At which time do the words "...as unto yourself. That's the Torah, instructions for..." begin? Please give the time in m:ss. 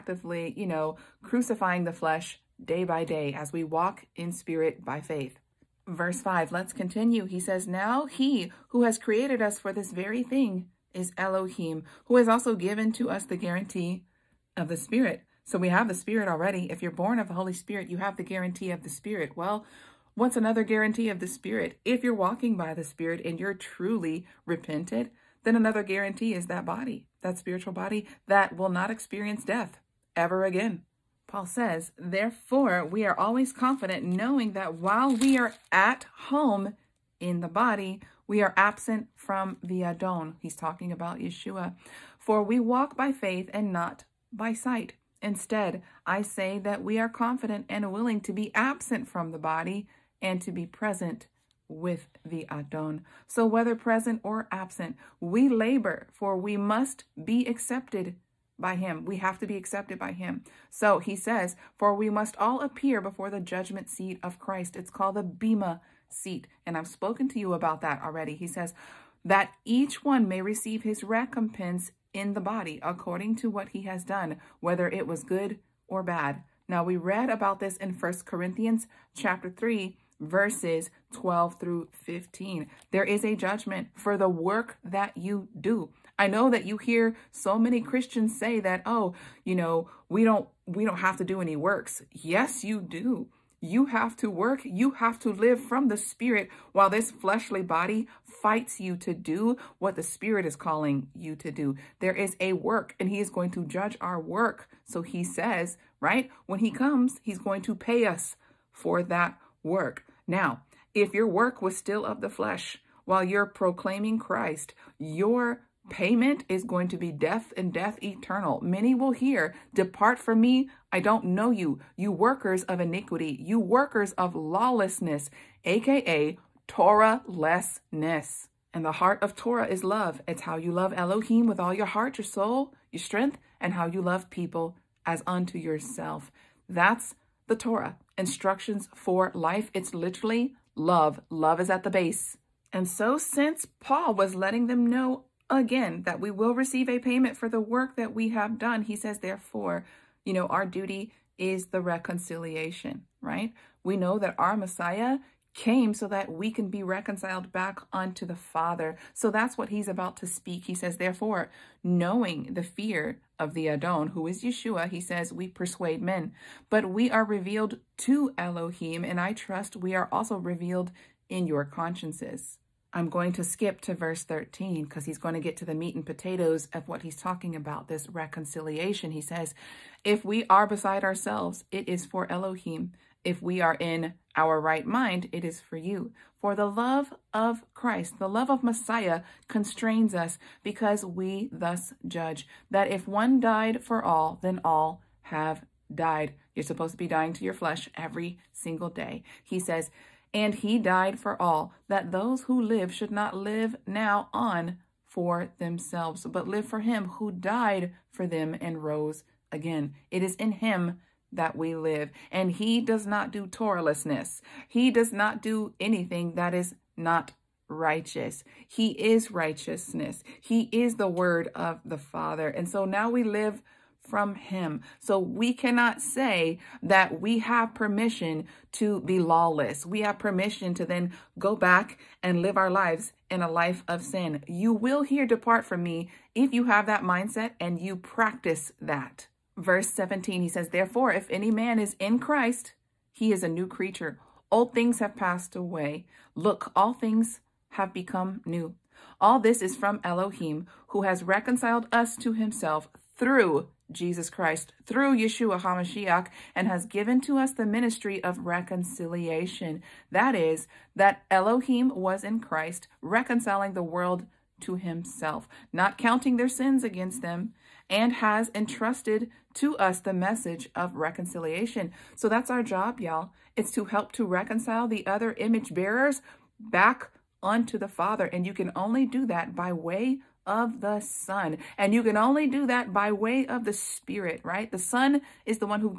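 2:15.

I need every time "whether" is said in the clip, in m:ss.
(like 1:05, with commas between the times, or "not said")
0:53, 1:14.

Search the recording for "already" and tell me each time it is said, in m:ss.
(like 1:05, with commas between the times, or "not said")
0:16, 1:08.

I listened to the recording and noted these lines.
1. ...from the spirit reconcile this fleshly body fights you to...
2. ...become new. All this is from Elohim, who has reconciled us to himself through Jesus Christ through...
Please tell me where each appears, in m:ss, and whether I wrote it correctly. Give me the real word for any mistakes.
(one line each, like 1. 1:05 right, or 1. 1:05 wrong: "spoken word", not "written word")
1. 1:35 wrong: "while", not "reconcile"
2. 4:07 right.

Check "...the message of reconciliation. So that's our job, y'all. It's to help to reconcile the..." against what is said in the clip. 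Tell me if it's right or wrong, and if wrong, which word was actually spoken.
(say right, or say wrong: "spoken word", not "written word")
right.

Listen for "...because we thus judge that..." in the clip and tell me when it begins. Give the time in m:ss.
3:10.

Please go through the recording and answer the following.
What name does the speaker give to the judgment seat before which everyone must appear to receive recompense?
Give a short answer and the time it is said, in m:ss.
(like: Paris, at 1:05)
Bema seat, at 1:05.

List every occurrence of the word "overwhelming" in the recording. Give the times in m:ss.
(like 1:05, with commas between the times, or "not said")
not said.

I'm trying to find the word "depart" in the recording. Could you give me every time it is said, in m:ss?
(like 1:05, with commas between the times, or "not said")
1:59, 3:55.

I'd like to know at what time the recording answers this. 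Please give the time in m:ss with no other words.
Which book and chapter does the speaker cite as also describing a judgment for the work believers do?
1:17.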